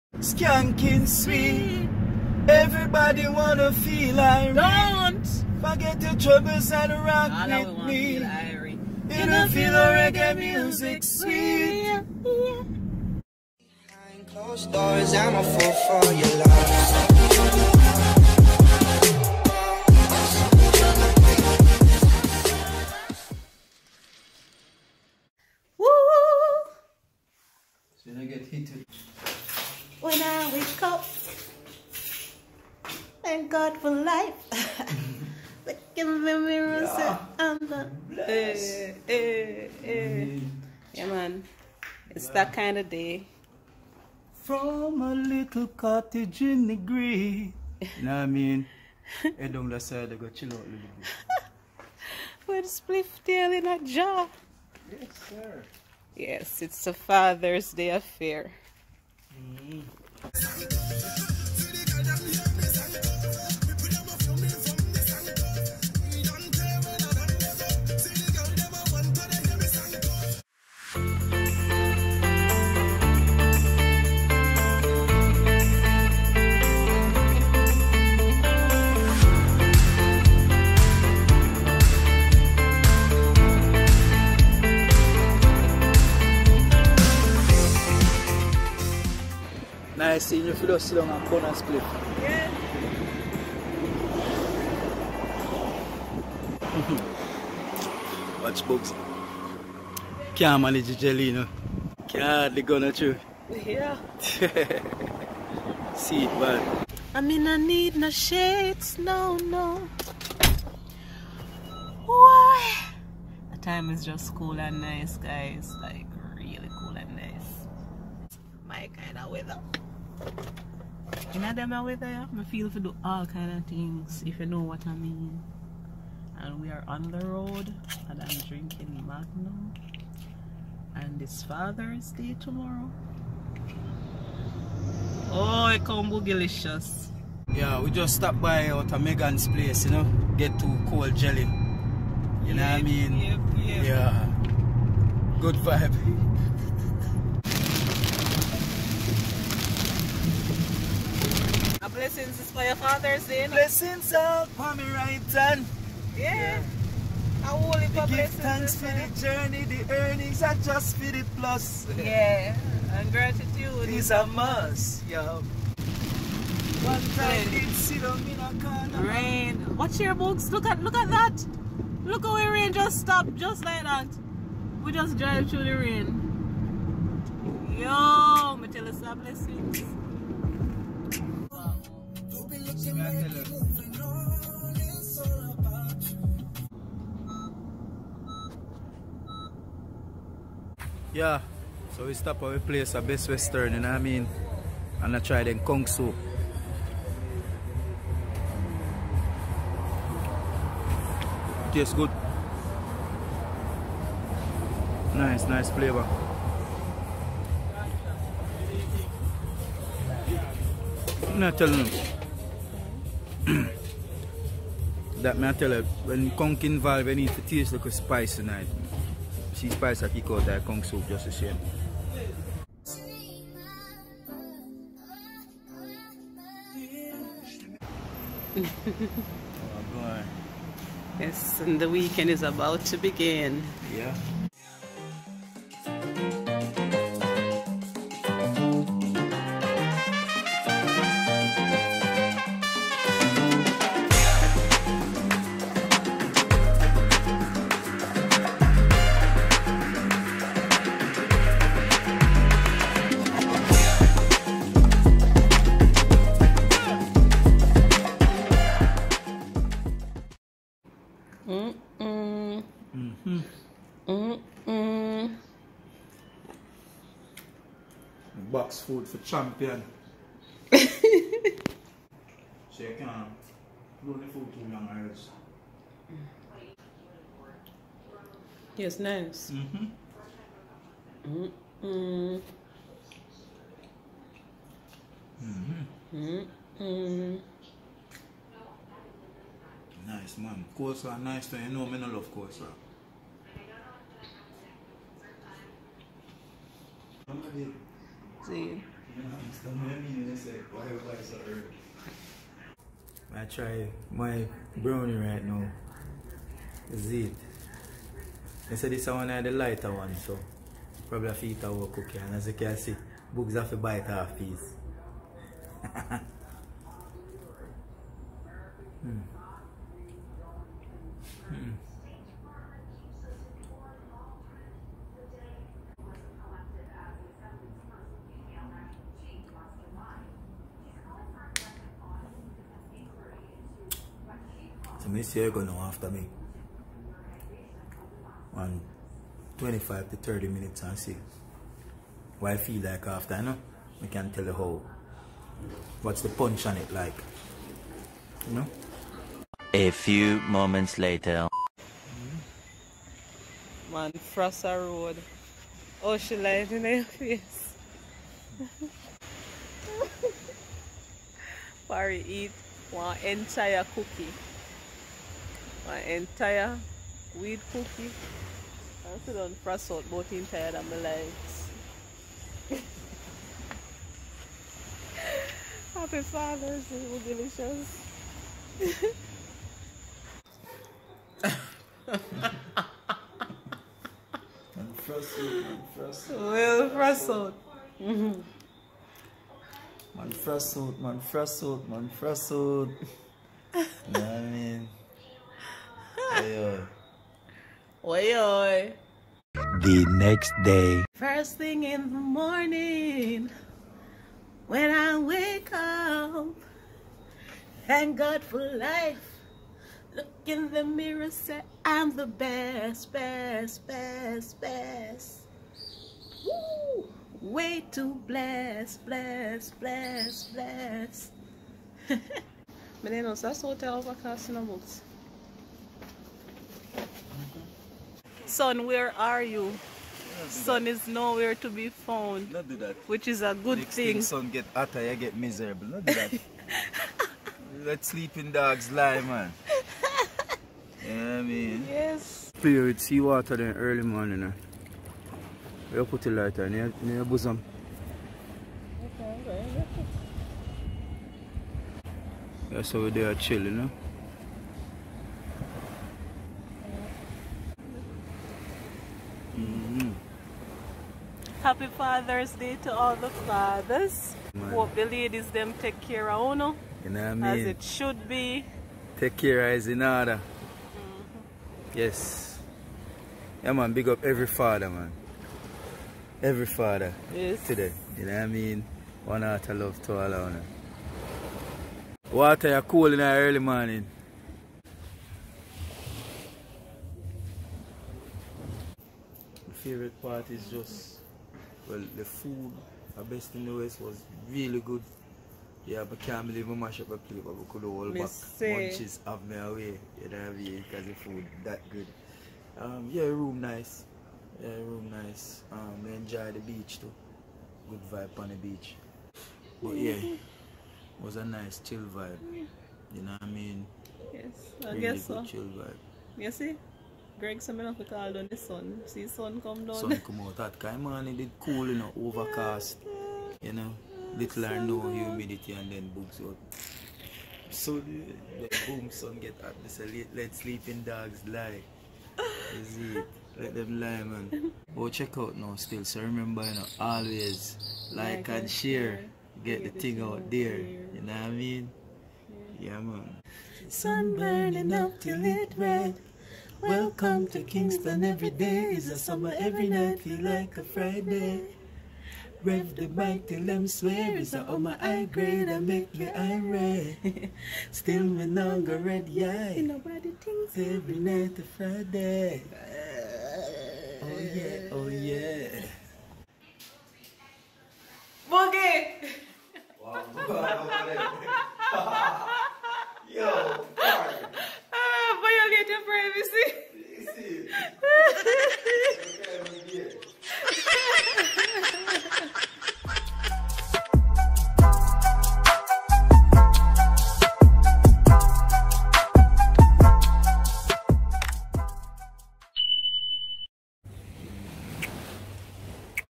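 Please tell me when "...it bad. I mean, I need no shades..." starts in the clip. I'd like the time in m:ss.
1:46.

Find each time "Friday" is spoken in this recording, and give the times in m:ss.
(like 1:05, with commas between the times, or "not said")
9:10, 9:21.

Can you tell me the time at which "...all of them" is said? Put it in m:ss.
8:00.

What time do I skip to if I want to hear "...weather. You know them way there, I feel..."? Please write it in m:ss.
1:59.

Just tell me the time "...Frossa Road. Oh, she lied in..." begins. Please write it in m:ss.
5:54.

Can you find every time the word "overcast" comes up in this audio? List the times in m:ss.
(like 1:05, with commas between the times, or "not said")
7:03, 8:42.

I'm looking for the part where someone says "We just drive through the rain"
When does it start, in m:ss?
2:54.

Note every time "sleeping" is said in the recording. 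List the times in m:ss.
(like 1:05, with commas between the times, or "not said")
7:18, 8:50.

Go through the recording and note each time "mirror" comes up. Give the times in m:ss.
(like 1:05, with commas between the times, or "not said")
0:36, 6:50.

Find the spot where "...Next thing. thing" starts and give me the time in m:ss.
7:13.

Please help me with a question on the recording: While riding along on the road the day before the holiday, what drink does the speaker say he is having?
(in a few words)
Magnum.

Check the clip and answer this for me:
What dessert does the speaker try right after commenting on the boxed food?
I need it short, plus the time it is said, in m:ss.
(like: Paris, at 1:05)
brownie, at 5:04.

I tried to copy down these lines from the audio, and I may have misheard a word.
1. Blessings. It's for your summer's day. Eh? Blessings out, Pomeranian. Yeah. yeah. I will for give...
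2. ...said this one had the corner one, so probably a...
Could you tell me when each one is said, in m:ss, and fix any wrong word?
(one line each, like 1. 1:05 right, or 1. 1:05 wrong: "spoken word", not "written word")
1. 2:32 wrong: "father", not "summer"
2. 5:08 wrong: "lighter", not "corner".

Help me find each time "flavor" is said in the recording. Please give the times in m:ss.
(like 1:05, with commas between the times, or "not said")
3:25.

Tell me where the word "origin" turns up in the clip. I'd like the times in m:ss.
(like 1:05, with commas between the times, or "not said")
not said.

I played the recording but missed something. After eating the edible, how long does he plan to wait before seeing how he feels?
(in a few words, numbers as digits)
25 to 30 minutes.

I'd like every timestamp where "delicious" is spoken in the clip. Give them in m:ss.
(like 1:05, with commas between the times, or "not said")
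2:16, 6:17.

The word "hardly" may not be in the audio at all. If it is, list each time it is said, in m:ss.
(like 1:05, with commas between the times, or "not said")
1:42.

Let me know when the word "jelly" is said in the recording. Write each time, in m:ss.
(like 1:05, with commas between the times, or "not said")
1:40, 2:21.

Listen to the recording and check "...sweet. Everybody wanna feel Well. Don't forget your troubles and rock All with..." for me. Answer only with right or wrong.
wrong.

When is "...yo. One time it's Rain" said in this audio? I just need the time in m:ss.
2:45.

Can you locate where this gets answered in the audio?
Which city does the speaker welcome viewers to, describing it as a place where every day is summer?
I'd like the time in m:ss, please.
9:07.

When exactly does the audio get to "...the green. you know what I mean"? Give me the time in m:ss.
0:46.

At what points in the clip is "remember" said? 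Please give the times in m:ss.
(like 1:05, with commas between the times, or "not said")
8:56.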